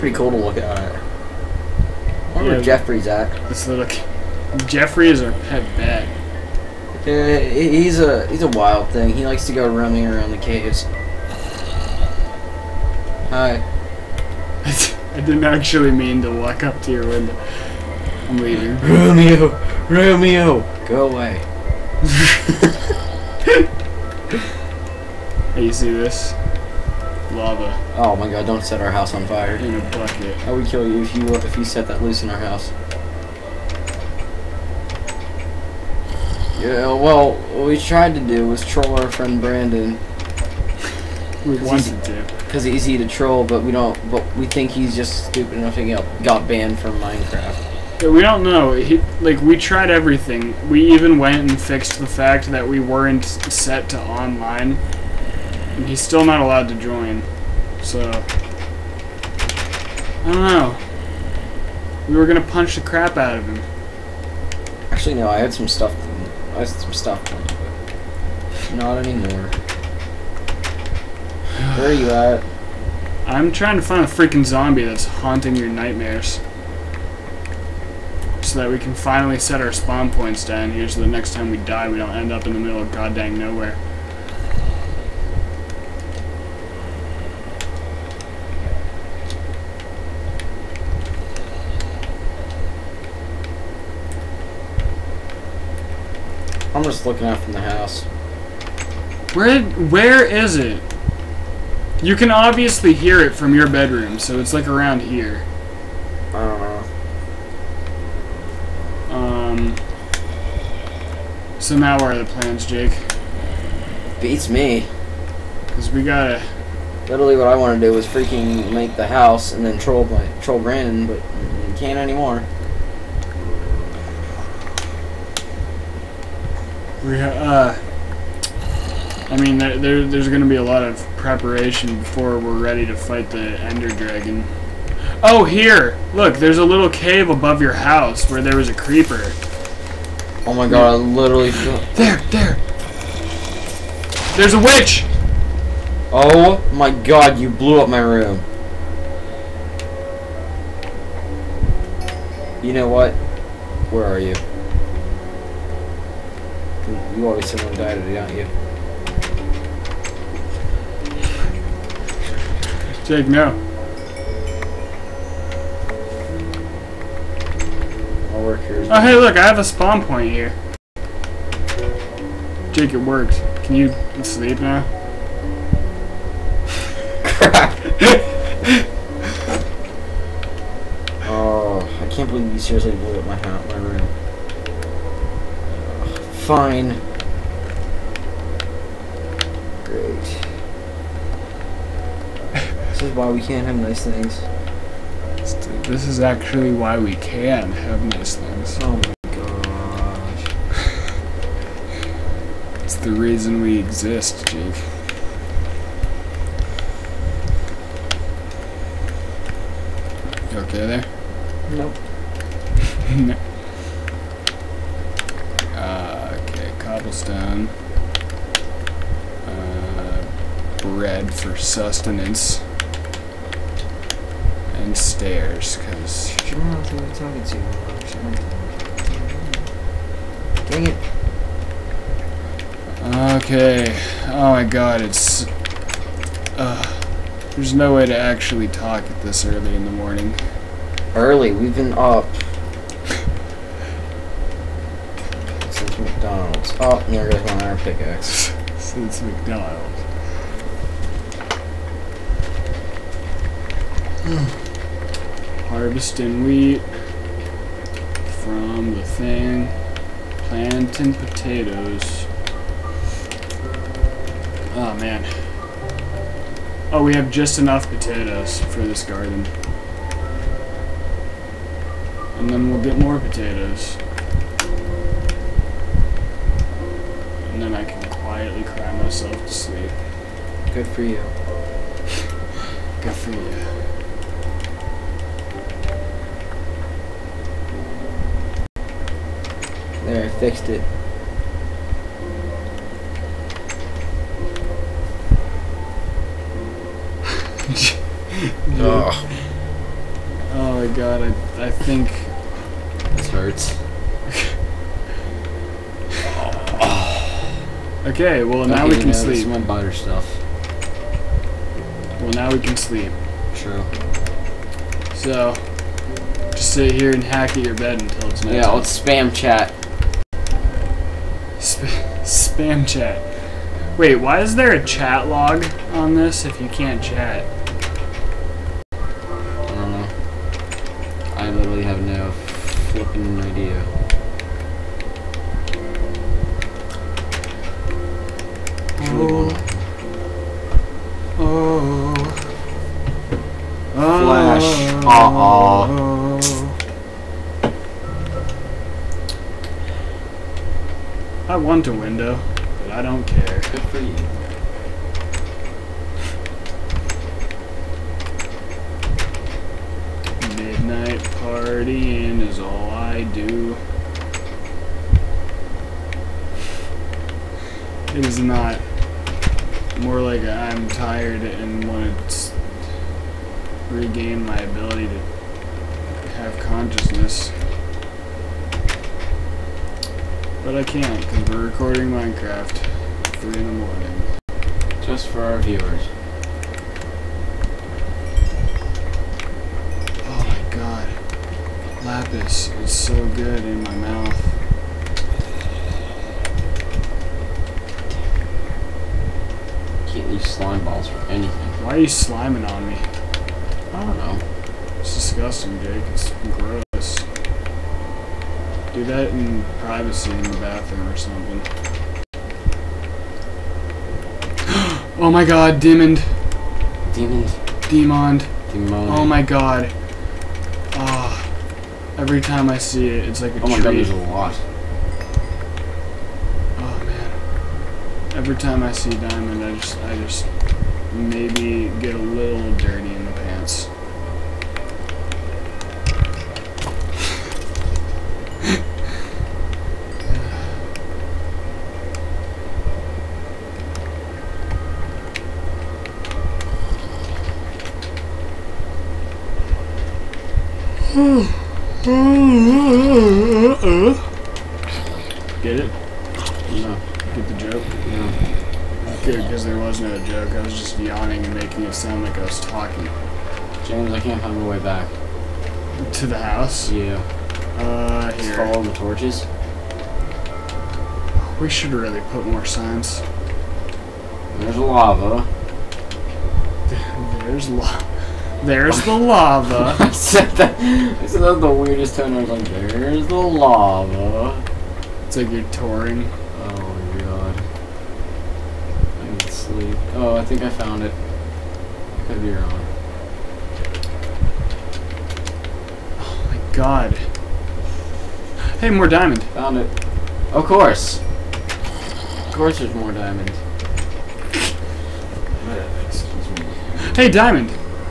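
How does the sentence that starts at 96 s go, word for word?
I'm just looking out from the house.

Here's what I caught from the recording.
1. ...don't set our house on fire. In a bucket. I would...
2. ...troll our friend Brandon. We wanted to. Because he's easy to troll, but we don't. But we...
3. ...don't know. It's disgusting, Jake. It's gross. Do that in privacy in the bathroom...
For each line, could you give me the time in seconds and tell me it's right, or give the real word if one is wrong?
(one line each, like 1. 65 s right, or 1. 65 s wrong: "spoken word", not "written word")
1. 28 s right
2. 38 s right
3. 404 s right.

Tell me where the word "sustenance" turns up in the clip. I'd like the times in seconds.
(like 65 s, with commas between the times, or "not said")
221 s.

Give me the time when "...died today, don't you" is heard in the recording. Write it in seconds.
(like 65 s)
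157 s.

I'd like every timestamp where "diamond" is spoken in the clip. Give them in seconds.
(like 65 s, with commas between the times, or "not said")
415 s, 429 s, 499 s, 503 s, 507 s.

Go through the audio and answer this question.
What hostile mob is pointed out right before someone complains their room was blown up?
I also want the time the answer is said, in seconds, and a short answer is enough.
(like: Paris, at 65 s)
A witch, at 144 s.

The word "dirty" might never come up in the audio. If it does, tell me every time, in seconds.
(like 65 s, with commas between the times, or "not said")
432 s.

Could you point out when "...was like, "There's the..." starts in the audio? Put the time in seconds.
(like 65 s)
482 s.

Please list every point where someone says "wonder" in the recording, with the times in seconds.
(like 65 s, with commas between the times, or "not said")
2 s.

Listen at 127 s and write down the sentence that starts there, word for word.
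We uh, I mean, there, there there's going to be a lot of preparation before we're ready to fight the Ender Dragon.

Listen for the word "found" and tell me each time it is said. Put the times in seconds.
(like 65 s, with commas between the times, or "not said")
490 s, 499 s.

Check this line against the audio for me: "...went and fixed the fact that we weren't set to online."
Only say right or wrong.
right.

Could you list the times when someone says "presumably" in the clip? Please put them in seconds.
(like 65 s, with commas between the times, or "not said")
not said.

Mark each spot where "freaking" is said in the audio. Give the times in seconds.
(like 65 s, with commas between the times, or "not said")
74 s, 118 s.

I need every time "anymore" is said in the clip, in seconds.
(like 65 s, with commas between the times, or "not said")
69 s, 121 s.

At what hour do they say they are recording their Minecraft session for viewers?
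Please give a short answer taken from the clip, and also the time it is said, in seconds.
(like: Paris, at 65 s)
3 in the morning, at 383 s.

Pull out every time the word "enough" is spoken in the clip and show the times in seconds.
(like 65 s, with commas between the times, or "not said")
45 s, 267 s.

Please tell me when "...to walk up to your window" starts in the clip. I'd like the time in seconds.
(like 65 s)
16 s.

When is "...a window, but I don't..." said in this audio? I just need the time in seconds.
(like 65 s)
351 s.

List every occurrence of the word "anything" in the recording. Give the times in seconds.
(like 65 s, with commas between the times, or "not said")
401 s.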